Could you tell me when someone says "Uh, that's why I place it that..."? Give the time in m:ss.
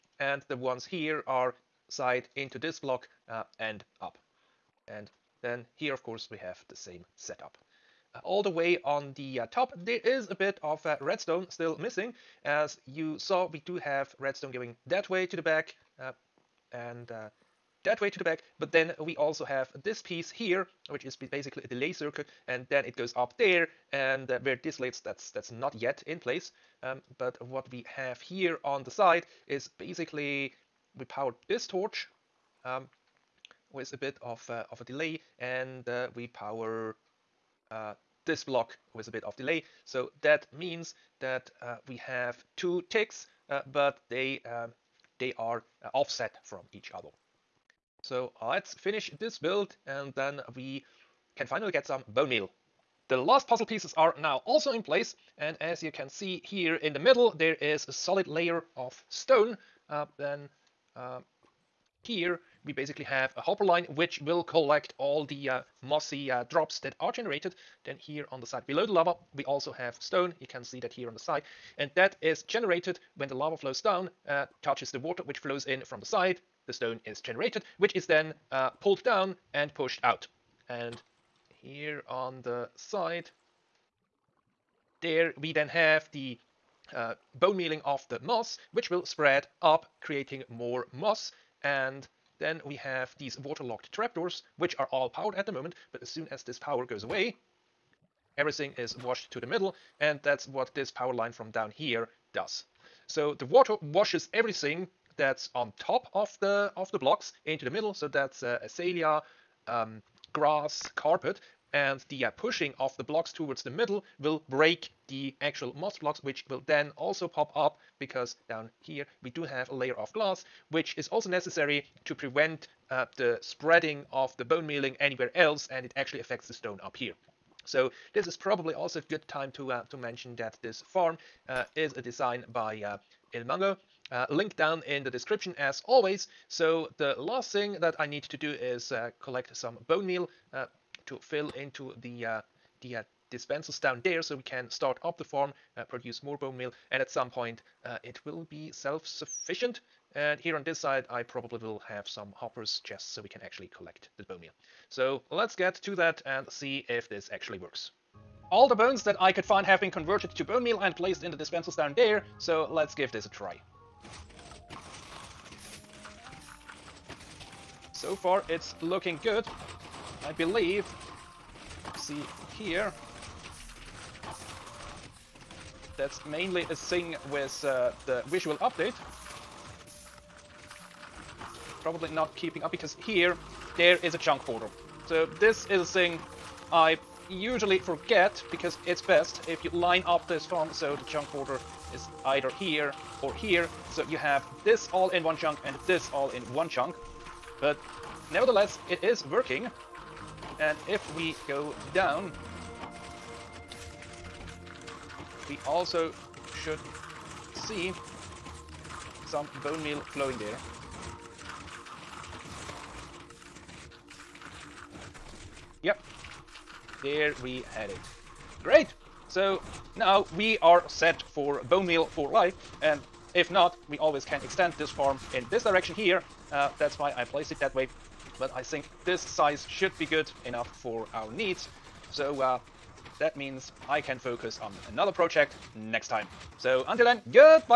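3:46.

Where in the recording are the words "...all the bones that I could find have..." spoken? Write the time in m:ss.
2:38.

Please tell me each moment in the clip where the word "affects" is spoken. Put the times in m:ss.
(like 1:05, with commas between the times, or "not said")
2:06.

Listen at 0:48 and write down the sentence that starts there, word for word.
So let's finish this build and then we can finally get some bone meal.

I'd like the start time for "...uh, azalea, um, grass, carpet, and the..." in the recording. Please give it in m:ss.
1:48.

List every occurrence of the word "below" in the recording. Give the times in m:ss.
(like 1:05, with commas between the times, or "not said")
1:08.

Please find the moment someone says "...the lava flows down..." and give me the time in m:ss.
1:13.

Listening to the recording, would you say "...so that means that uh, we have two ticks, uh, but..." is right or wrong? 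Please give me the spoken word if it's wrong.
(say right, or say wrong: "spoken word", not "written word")
right.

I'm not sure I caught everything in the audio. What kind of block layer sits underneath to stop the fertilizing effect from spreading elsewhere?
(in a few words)
Glass.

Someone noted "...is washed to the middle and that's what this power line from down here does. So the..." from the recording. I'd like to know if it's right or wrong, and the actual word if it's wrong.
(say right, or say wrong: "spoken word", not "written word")
right.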